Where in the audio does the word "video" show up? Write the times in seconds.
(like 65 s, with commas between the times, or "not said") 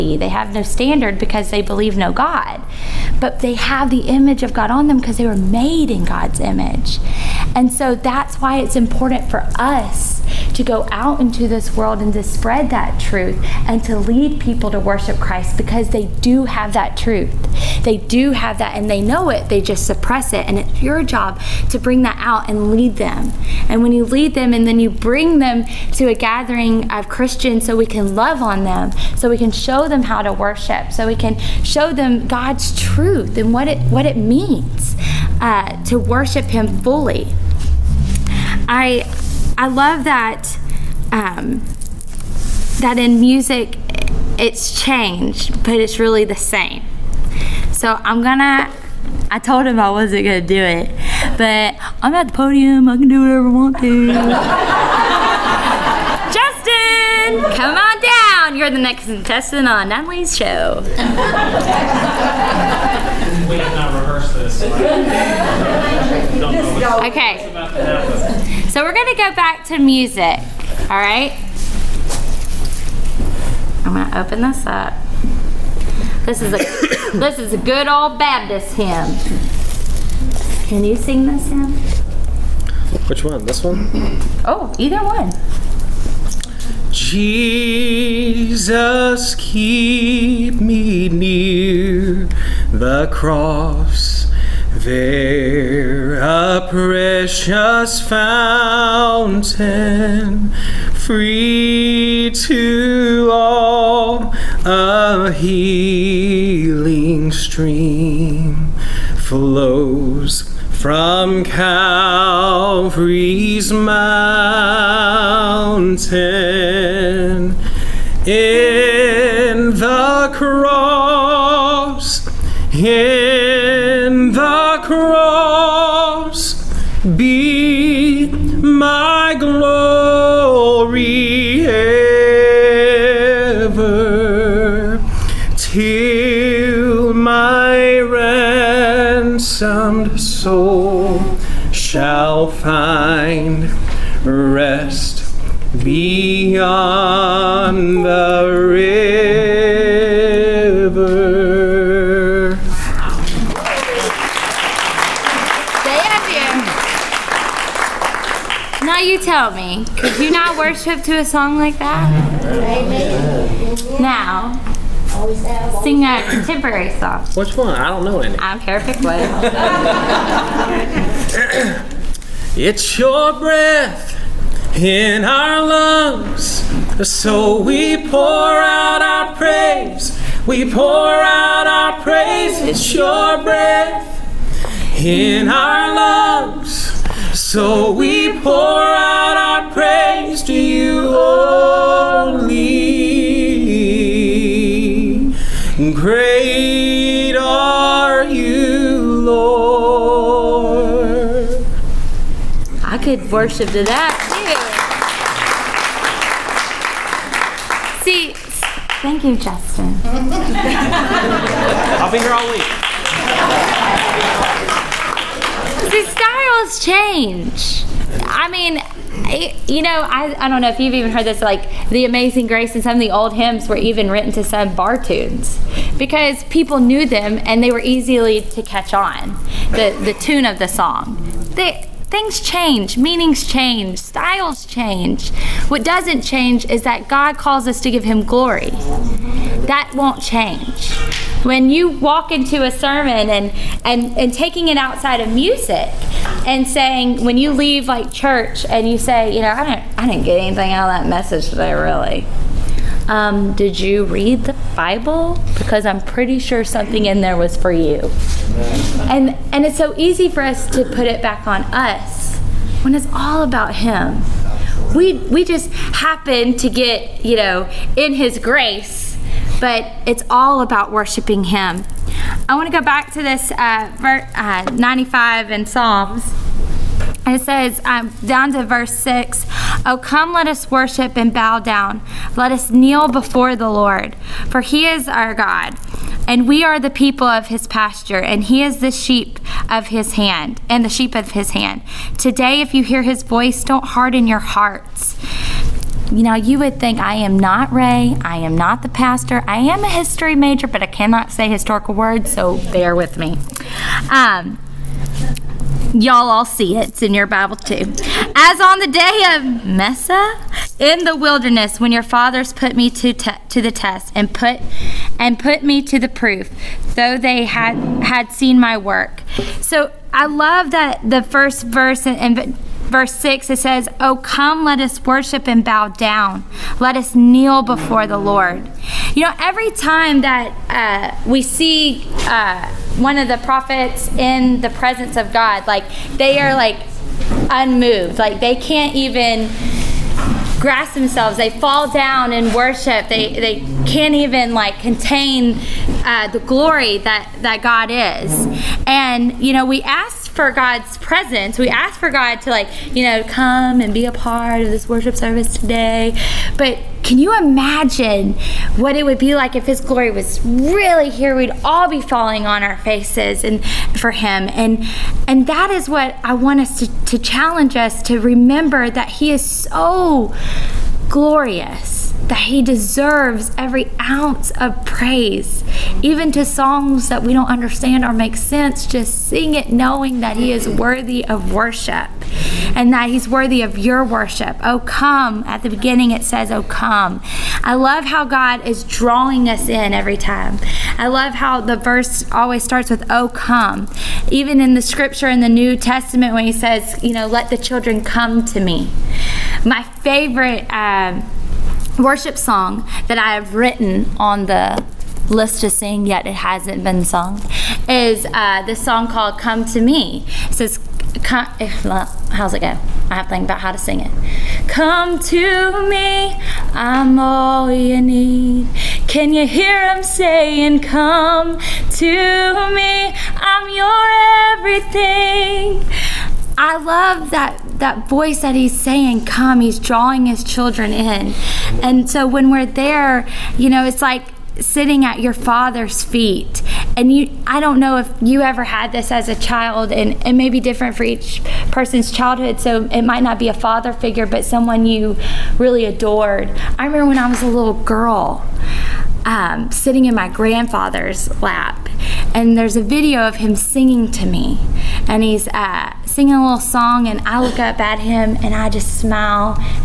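452 s.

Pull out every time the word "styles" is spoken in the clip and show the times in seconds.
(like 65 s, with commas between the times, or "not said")
216 s, 233 s.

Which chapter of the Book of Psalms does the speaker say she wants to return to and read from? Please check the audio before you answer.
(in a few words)
95.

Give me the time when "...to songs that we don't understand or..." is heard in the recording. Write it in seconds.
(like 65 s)
376 s.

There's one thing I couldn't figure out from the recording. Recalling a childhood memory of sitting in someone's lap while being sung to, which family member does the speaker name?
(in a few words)
Grandfather.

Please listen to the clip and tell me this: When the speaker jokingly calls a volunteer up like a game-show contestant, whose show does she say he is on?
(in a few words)
Natalie's show.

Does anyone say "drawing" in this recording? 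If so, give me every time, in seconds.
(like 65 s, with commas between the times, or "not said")
388 s, 429 s.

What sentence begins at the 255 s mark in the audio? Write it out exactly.
Because I'm pretty sure something in there was for you.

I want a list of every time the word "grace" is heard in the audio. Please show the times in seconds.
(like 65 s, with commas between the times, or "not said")
222 s, 268 s.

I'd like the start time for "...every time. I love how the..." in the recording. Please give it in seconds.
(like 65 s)
389 s.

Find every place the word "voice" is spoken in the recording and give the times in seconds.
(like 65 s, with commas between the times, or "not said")
293 s, 428 s.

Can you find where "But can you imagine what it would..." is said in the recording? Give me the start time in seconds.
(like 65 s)
356 s.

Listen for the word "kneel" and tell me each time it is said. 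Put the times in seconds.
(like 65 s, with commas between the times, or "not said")
282 s, 327 s.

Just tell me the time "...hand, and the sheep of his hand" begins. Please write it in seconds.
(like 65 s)
290 s.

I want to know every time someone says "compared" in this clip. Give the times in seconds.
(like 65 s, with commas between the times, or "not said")
not said.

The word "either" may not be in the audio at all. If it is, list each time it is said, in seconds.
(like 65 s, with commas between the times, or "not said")
84 s.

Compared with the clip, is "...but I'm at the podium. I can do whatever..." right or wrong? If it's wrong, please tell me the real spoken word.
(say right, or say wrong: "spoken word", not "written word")
right.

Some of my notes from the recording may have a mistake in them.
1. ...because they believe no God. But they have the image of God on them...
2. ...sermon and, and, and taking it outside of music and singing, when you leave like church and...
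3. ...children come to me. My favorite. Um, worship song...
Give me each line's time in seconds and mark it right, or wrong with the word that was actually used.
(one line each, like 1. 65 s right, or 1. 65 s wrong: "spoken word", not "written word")
1. 1 s right
2. 242 s wrong: "saying", not "singing"
3. 397 s right.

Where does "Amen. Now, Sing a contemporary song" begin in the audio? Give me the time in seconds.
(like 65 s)
162 s.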